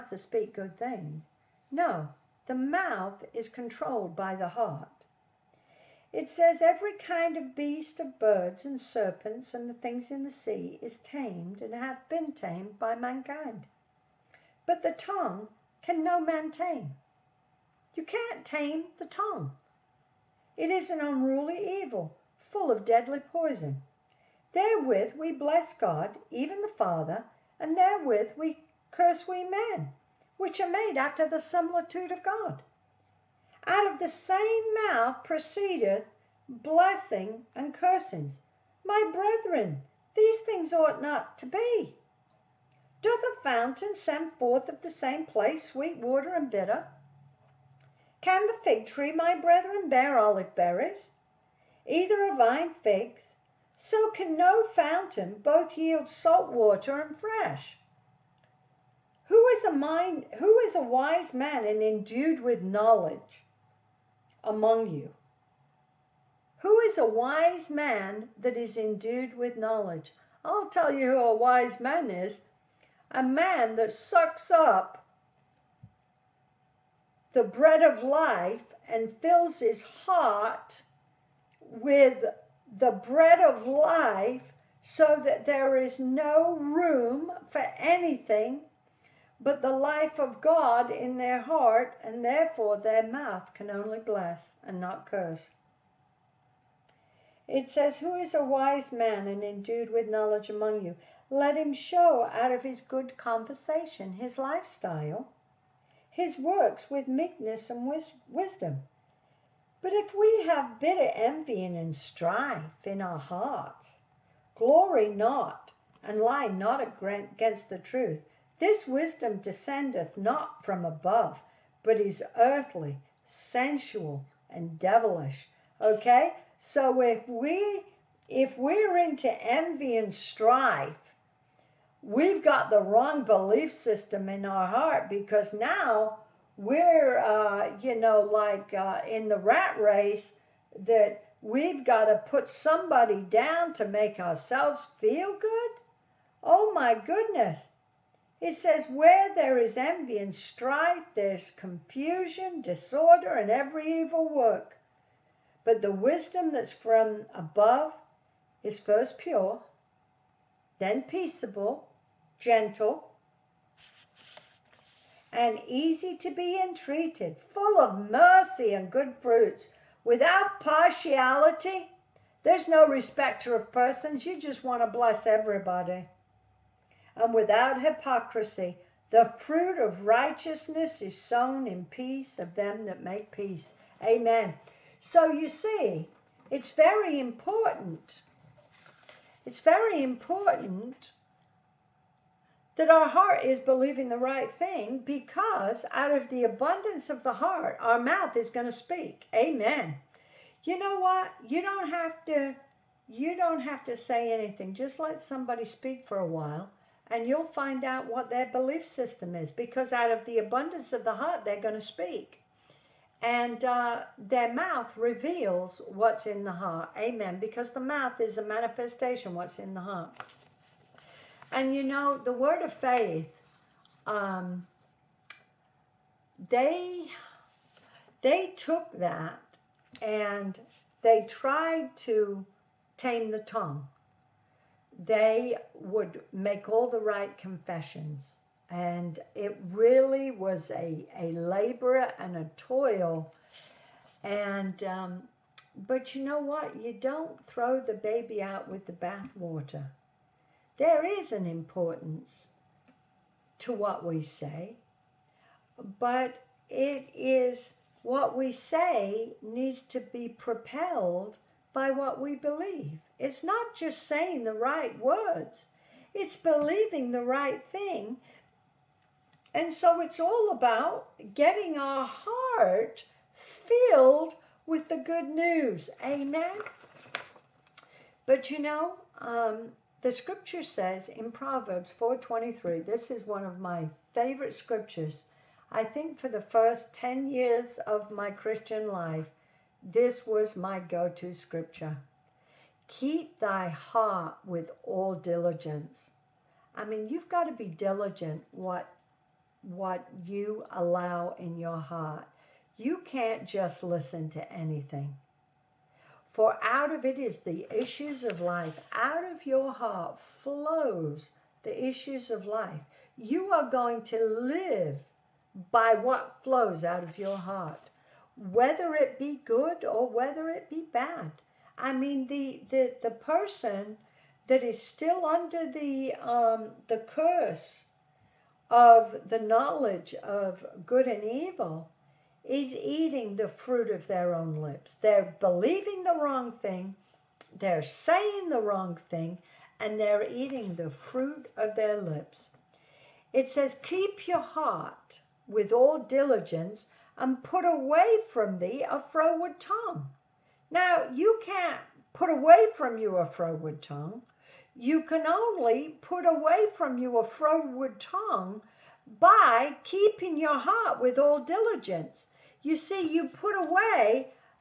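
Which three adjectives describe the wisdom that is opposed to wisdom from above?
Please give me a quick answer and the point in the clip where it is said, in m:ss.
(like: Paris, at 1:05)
Earthly, sensual, and devilish, at 2:02.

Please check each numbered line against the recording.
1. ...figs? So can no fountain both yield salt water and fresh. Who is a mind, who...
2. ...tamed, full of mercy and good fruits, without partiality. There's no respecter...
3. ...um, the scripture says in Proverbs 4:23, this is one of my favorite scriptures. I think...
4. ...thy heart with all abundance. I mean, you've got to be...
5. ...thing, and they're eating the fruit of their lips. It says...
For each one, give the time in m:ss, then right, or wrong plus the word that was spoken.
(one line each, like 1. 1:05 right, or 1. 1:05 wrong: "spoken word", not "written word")
1. 0:52 right
2. 2:46 wrong: "entreated", not "tamed"
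3. 4:39 right
4. 4:53 wrong: "diligence", not "abundance"
5. 5:39 right.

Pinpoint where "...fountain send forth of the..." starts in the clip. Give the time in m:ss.
0:43.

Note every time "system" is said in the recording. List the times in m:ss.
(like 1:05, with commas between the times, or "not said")
2:13, 3:28.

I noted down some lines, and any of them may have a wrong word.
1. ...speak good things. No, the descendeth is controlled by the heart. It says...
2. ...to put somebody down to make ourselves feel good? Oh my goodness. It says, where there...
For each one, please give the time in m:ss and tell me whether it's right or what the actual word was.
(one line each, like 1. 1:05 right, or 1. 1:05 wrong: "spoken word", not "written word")
1. 0:00 wrong: "mouth", not "descendeth"
2. 2:22 right.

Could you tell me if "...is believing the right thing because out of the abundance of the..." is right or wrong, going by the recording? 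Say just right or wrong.
right.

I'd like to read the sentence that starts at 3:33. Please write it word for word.
And uh, their mouth reveals what's in the heart.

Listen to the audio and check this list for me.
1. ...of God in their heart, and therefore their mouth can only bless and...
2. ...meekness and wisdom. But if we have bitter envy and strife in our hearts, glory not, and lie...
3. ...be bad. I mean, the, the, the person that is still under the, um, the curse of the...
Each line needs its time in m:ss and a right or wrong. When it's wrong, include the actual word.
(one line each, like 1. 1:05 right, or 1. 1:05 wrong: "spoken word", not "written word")
1. 1:30 right
2. 1:47 right
3. 5:20 right.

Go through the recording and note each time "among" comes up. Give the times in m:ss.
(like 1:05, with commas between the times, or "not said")
1:04, 1:40.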